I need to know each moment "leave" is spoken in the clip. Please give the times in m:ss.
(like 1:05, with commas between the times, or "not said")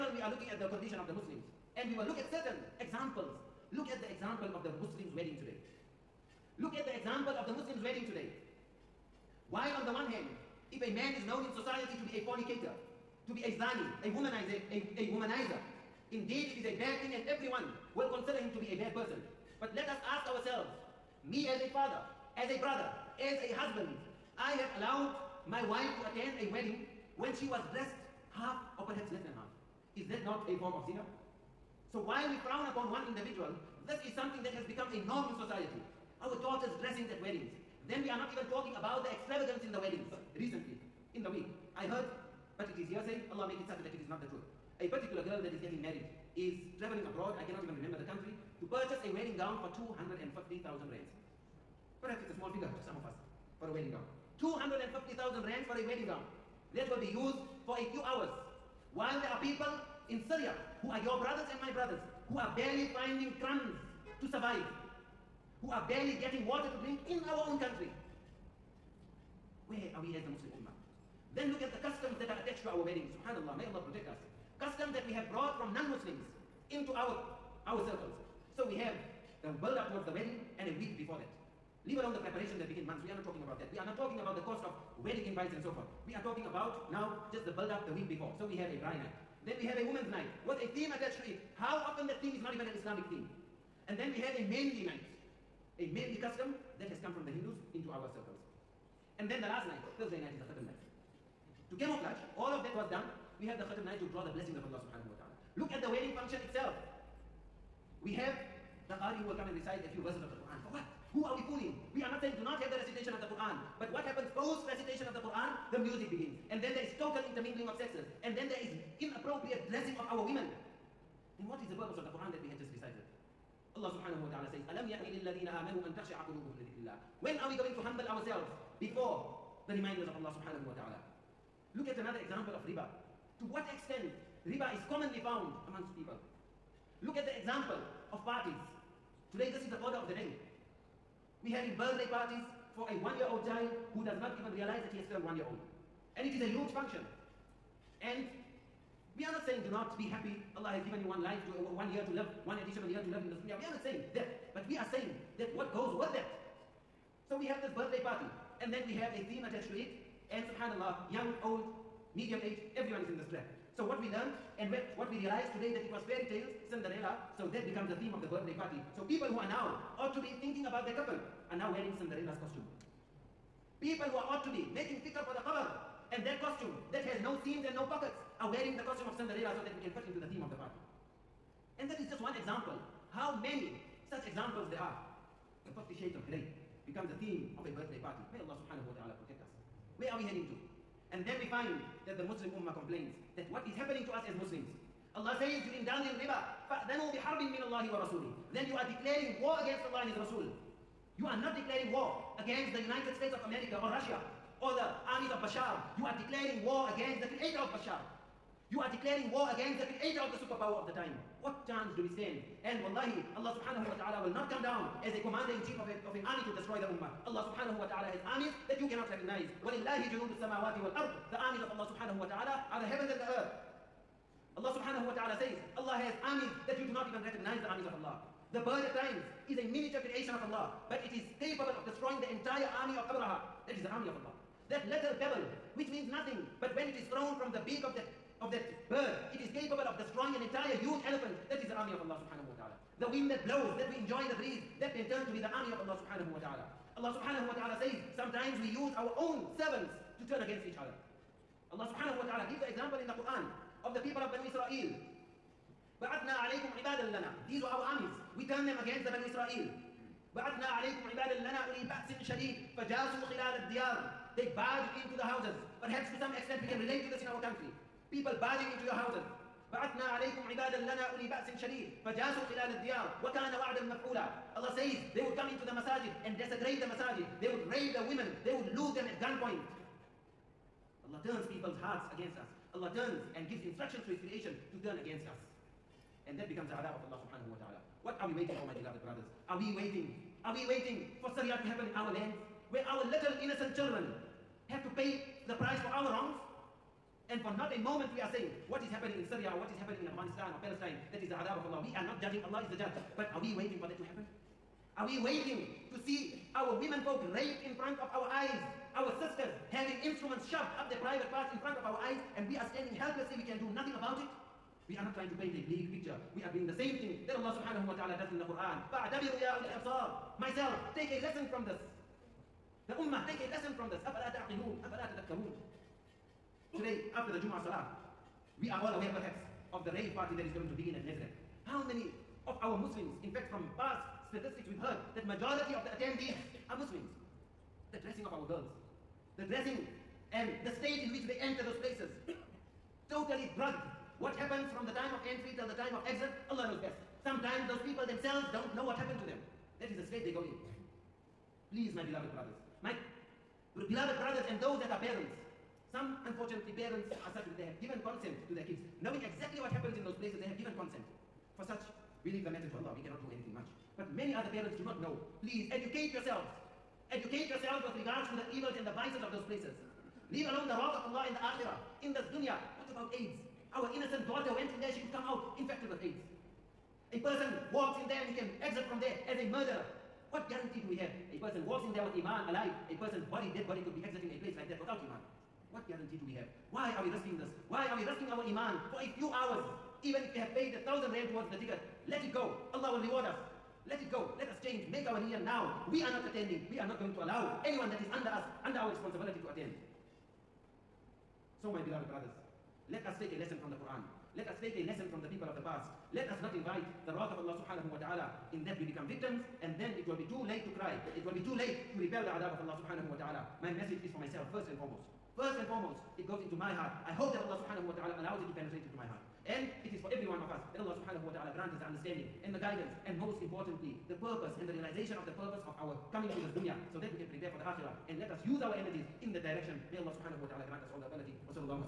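1:21, 6:02, 6:10.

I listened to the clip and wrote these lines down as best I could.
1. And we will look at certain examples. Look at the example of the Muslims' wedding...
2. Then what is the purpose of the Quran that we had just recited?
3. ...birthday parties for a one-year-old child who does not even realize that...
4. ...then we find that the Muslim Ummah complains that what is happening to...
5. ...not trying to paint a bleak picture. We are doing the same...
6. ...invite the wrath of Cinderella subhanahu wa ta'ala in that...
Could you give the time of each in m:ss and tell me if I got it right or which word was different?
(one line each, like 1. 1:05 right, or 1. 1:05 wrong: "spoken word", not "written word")
1. 0:01 right
2. 2:01 right
3. 2:21 right
4. 3:11 right
5. 5:15 right
6. 6:46 wrong: "Allah", not "Cinderella".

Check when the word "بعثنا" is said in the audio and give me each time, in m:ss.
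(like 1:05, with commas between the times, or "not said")
4:29.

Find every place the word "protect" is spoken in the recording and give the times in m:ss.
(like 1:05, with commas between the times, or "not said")
1:13, 3:09.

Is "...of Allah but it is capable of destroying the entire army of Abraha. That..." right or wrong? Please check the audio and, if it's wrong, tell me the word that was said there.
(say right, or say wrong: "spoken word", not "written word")
right.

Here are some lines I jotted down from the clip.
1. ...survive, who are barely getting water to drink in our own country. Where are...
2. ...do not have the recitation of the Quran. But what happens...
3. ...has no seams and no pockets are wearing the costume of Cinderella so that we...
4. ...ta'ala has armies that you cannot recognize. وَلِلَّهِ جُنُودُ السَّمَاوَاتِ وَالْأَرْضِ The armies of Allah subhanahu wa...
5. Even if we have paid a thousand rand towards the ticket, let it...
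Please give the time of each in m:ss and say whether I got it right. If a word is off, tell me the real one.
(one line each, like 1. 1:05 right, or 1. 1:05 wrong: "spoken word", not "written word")
1. 1:04 right
2. 1:52 right
3. 2:57 right
4. 3:37 right
5. 6:30 right.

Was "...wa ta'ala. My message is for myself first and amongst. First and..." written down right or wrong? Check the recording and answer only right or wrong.
wrong.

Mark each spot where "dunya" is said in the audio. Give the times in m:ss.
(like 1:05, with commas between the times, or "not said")
2:33, 6:12, 7:06.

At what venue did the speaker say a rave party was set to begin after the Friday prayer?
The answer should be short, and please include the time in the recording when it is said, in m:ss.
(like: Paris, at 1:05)
Nasrec, at 5:31.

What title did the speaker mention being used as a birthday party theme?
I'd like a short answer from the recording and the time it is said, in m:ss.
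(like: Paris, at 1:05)
50 Shades of Grey, at 3:05.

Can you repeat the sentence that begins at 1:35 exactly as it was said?
A mehndi custom that has come from the Hindus into our circles.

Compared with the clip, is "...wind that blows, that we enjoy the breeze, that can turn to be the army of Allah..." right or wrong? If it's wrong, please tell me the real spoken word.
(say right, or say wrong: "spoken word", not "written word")
right.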